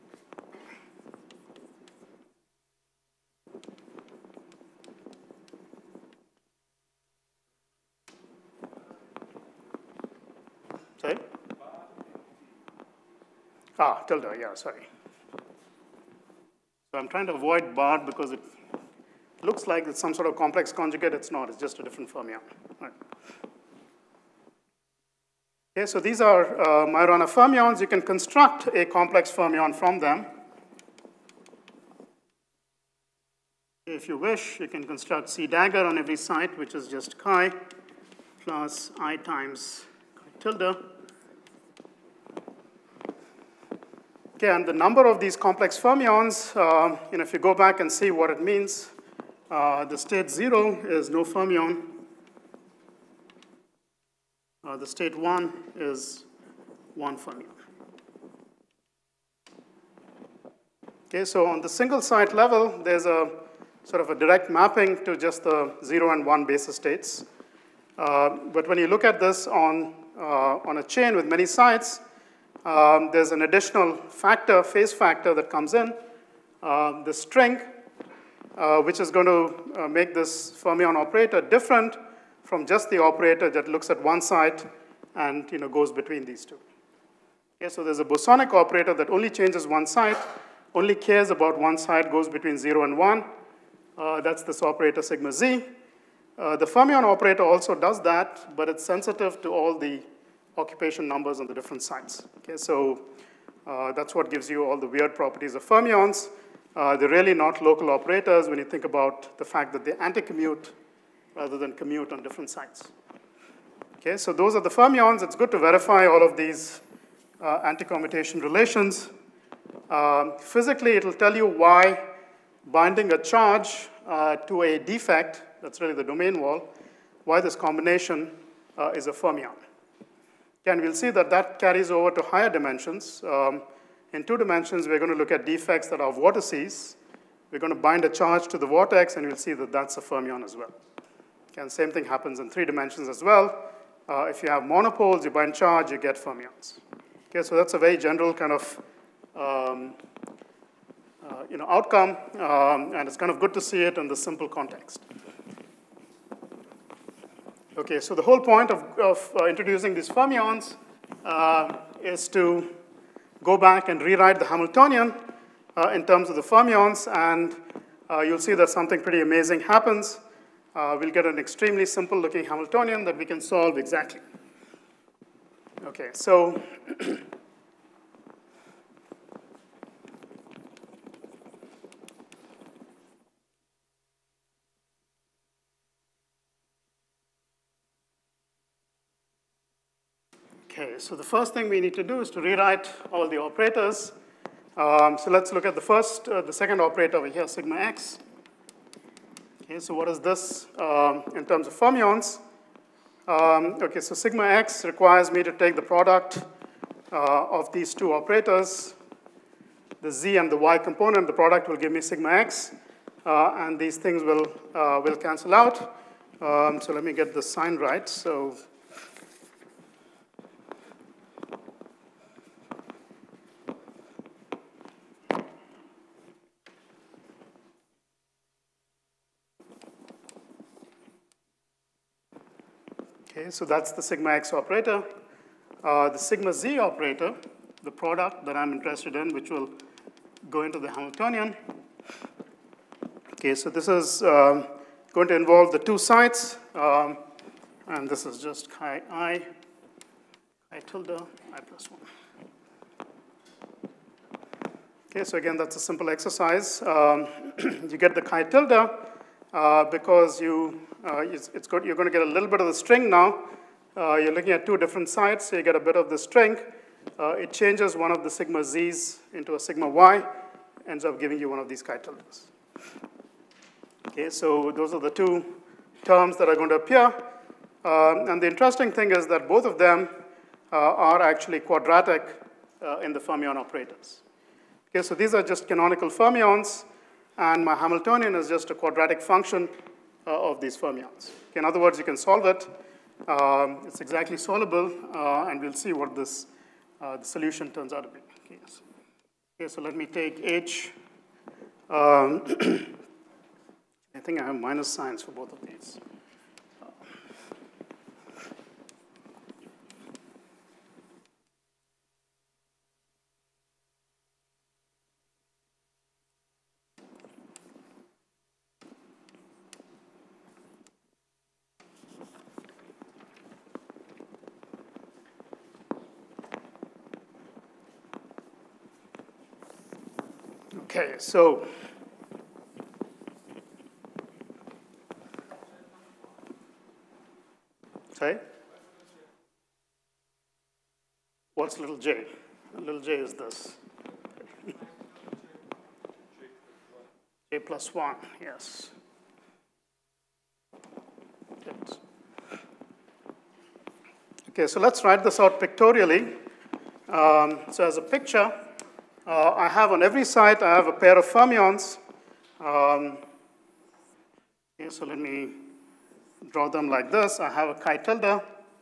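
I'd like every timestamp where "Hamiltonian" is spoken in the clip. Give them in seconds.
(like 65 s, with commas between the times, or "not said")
164 s, 172 s, 240 s, 287 s.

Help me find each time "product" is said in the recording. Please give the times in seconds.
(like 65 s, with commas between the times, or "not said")
205 s, 211 s, 237 s.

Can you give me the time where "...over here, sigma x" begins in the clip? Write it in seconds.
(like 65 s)
197 s.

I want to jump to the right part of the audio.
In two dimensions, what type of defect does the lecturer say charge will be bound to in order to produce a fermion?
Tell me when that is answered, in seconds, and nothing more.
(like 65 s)
136 s.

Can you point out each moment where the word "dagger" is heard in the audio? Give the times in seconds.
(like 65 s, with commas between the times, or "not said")
35 s.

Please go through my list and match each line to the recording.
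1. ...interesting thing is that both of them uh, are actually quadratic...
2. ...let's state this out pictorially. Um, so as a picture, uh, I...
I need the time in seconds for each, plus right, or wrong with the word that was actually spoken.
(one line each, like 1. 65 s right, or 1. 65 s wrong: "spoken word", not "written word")
1. 278 s right
2. 354 s wrong: "write", not "state".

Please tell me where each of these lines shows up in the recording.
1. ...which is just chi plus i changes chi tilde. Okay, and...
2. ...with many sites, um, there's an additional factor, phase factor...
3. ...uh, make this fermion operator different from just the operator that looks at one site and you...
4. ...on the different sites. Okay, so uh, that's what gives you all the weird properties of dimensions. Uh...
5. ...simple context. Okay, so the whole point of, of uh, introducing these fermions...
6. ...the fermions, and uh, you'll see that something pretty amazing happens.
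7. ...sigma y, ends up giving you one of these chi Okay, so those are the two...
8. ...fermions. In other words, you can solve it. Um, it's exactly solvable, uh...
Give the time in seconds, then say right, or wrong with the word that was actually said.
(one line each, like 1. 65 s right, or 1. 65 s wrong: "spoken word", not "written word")
1. 36 s wrong: "times", not "changes"
2. 71 s right
3. 79 s right
4. 101 s wrong: "fermions", not "dimensions"
5. 154 s right
6. 166 s right
7. 269 s right
8. 290 s right.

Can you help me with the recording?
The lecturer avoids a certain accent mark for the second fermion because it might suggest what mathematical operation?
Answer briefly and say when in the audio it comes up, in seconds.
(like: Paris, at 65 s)
complex conjugate, at 20 s.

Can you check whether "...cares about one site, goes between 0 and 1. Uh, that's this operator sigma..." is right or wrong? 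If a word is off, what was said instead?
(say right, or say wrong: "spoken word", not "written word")
right.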